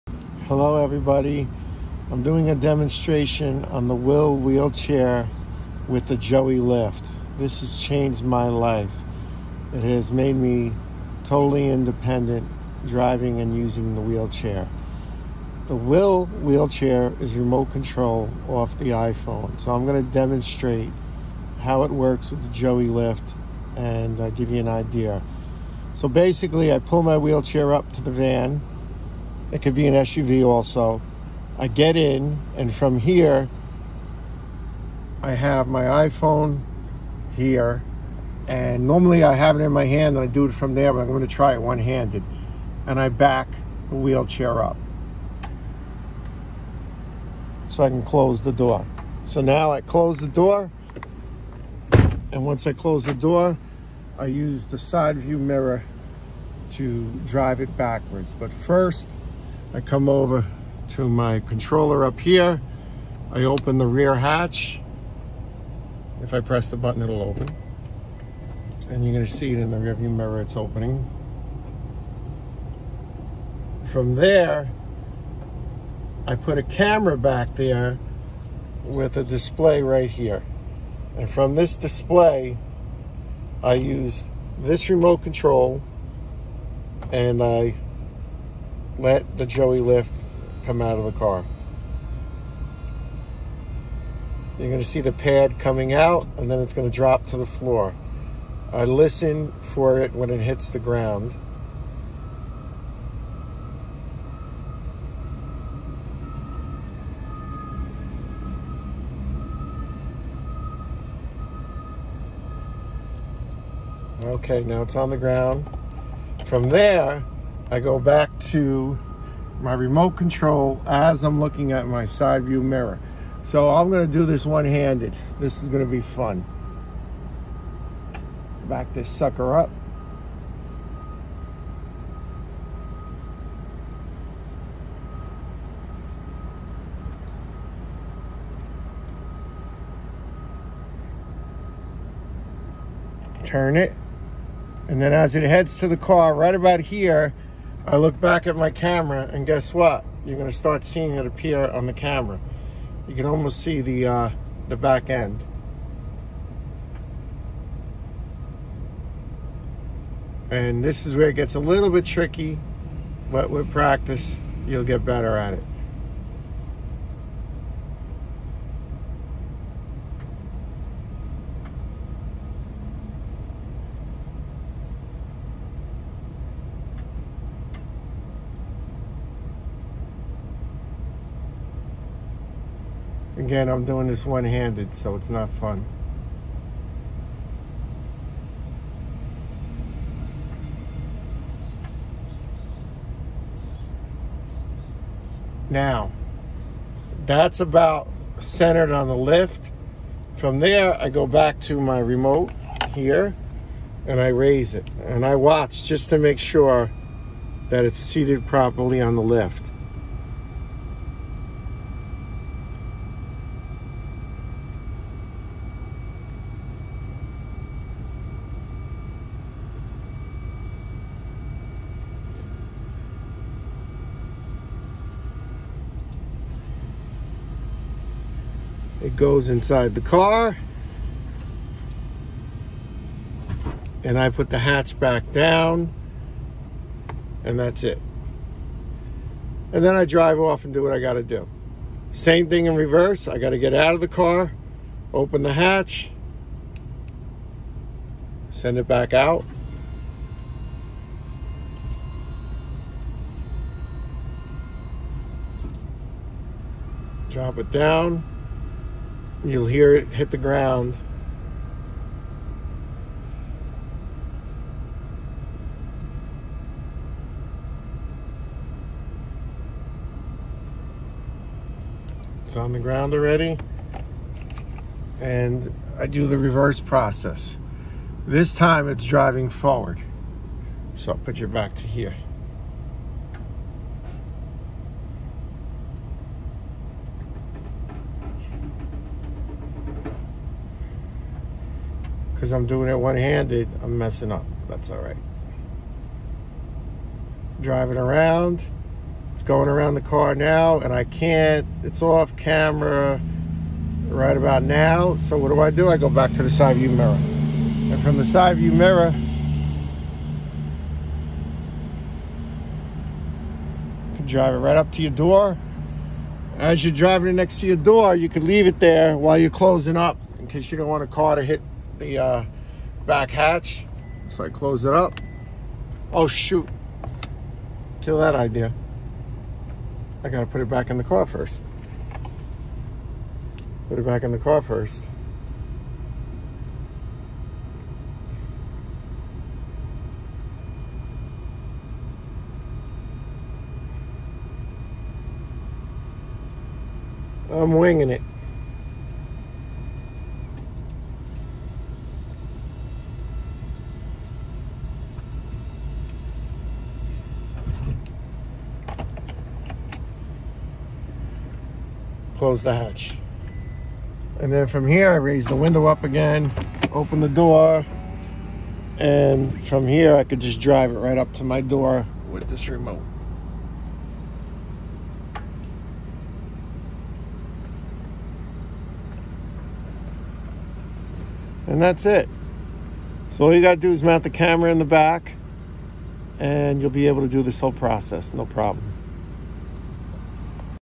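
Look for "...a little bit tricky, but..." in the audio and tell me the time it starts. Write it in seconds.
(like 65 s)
161 s.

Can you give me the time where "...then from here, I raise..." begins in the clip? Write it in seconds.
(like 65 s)
364 s.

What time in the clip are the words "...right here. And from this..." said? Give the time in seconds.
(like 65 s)
79 s.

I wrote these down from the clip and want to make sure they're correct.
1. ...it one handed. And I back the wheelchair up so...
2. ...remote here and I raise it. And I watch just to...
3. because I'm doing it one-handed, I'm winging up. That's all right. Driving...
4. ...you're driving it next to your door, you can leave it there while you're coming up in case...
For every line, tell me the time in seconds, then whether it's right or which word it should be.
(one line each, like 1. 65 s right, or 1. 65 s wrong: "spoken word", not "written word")
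1. 41 s right
2. 201 s right
3. 292 s wrong: "messing", not "winging"
4. 316 s wrong: "closing", not "coming".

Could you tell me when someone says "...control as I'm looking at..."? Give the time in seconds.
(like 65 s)
120 s.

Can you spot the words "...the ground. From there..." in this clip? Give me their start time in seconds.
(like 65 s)
115 s.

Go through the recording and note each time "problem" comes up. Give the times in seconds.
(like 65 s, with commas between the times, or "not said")
388 s.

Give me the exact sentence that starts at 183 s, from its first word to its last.
Again, I'm doing this one-handed, so it's not fun.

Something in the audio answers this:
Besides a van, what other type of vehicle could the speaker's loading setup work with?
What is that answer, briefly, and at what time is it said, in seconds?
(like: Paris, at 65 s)
SUV, at 29 s.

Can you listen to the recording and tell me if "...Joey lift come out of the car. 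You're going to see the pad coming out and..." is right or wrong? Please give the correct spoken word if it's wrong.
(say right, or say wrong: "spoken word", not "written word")
right.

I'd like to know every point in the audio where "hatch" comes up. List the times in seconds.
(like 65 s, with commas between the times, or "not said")
64 s, 234 s, 245 s, 323 s, 362 s.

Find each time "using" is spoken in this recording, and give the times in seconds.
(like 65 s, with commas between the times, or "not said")
13 s.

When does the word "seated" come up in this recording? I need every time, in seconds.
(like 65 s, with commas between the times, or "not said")
207 s.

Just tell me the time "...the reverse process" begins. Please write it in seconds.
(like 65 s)
276 s.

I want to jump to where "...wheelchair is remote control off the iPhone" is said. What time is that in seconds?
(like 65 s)
16 s.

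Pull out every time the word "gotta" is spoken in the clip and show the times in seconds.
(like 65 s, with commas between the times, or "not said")
330 s, 383 s.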